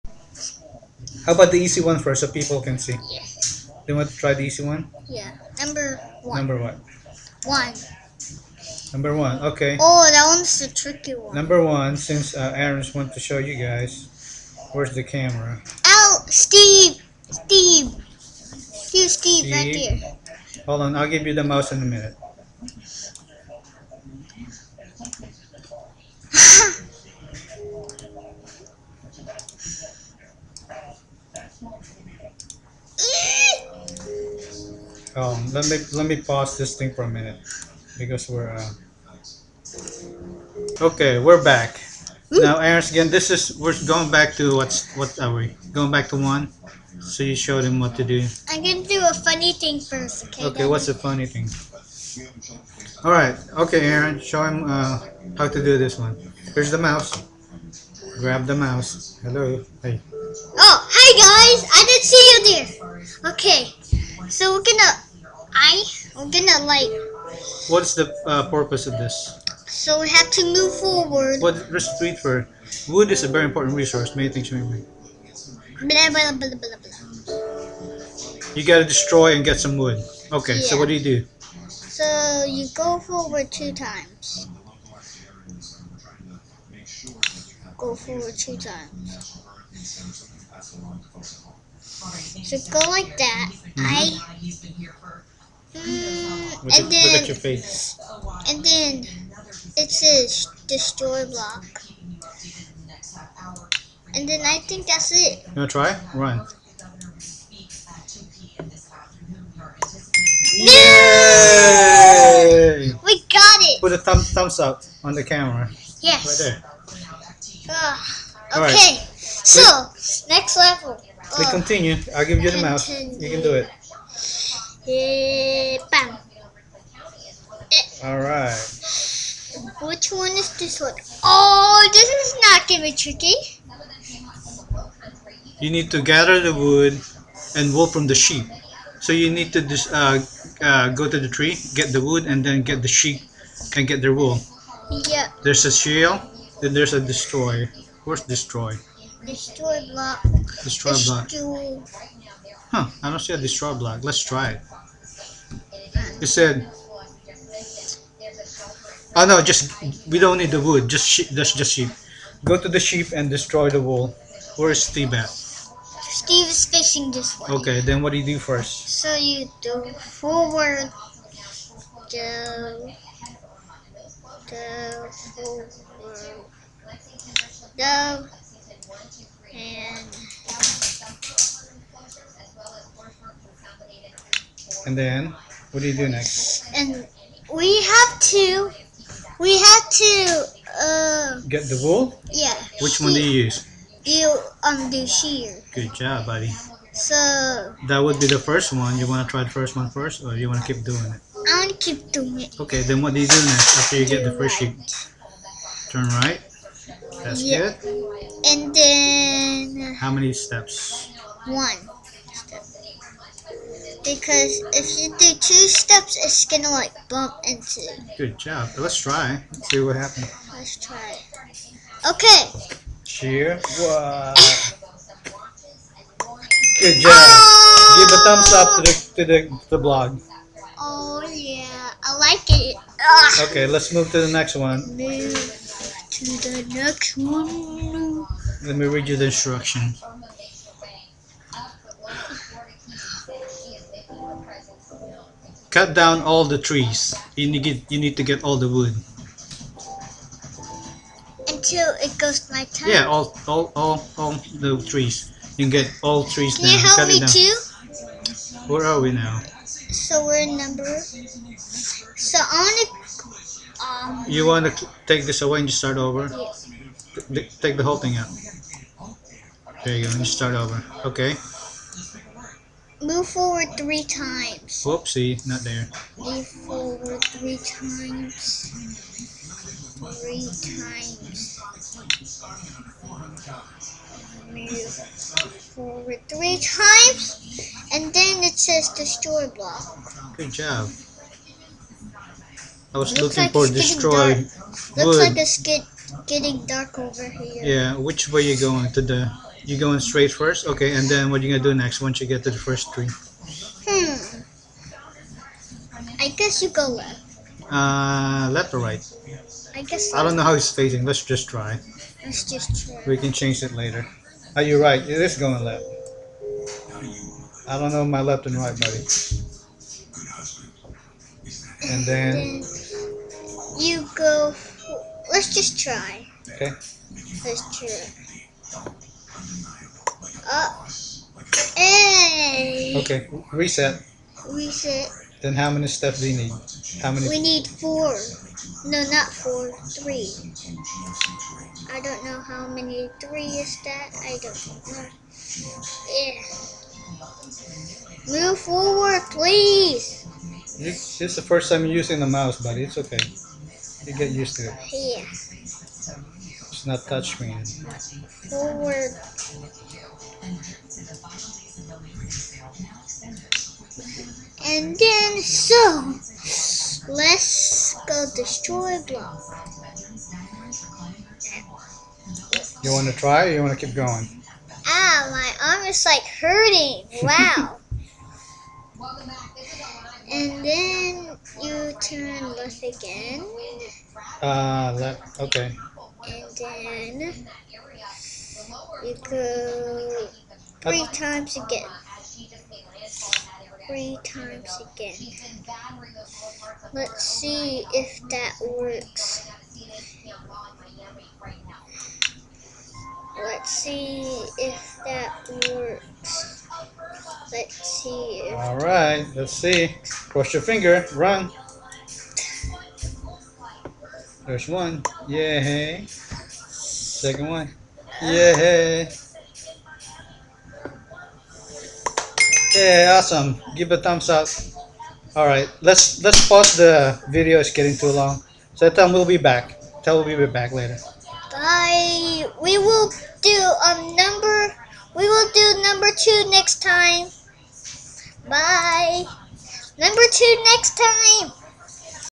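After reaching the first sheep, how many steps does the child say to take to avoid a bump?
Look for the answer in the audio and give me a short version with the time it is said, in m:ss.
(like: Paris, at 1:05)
1, at 3:31.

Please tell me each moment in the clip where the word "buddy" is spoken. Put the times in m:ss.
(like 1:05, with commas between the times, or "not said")
3:16, 5:18, 5:52.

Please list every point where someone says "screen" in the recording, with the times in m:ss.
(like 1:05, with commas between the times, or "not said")
5:57.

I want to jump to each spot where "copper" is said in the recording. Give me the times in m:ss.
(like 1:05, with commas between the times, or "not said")
not said.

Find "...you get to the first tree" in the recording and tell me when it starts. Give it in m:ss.
5:02.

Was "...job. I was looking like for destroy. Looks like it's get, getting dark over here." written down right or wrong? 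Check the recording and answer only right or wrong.
right.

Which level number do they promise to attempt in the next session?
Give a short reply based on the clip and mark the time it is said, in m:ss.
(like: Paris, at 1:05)
2, at 7:15.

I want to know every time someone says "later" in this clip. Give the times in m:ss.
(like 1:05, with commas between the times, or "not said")
5:13, 7:10.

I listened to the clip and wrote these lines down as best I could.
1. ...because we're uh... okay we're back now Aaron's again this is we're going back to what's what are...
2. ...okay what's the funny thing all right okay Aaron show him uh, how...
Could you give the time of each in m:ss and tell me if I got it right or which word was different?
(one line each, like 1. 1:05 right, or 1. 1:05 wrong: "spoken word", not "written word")
1. 0:37 right
2. 0:50 right.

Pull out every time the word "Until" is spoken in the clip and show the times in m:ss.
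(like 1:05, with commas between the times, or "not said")
4:11.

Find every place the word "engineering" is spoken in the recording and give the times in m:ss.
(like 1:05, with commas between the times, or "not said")
not said.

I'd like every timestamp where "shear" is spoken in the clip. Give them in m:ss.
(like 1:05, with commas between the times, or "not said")
3:15, 3:43.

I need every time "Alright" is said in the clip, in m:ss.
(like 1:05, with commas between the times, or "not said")
2:08.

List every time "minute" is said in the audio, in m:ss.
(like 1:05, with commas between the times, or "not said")
0:21, 0:37.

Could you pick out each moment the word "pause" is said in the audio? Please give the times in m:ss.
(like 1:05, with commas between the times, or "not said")
0:36, 7:06.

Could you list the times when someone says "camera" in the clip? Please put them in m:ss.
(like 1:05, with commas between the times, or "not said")
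0:15, 1:55.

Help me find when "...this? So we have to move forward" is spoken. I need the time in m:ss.
1:08.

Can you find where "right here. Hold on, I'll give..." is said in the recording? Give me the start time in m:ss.
0:19.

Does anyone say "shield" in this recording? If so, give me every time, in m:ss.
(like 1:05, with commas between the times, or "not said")
2:25.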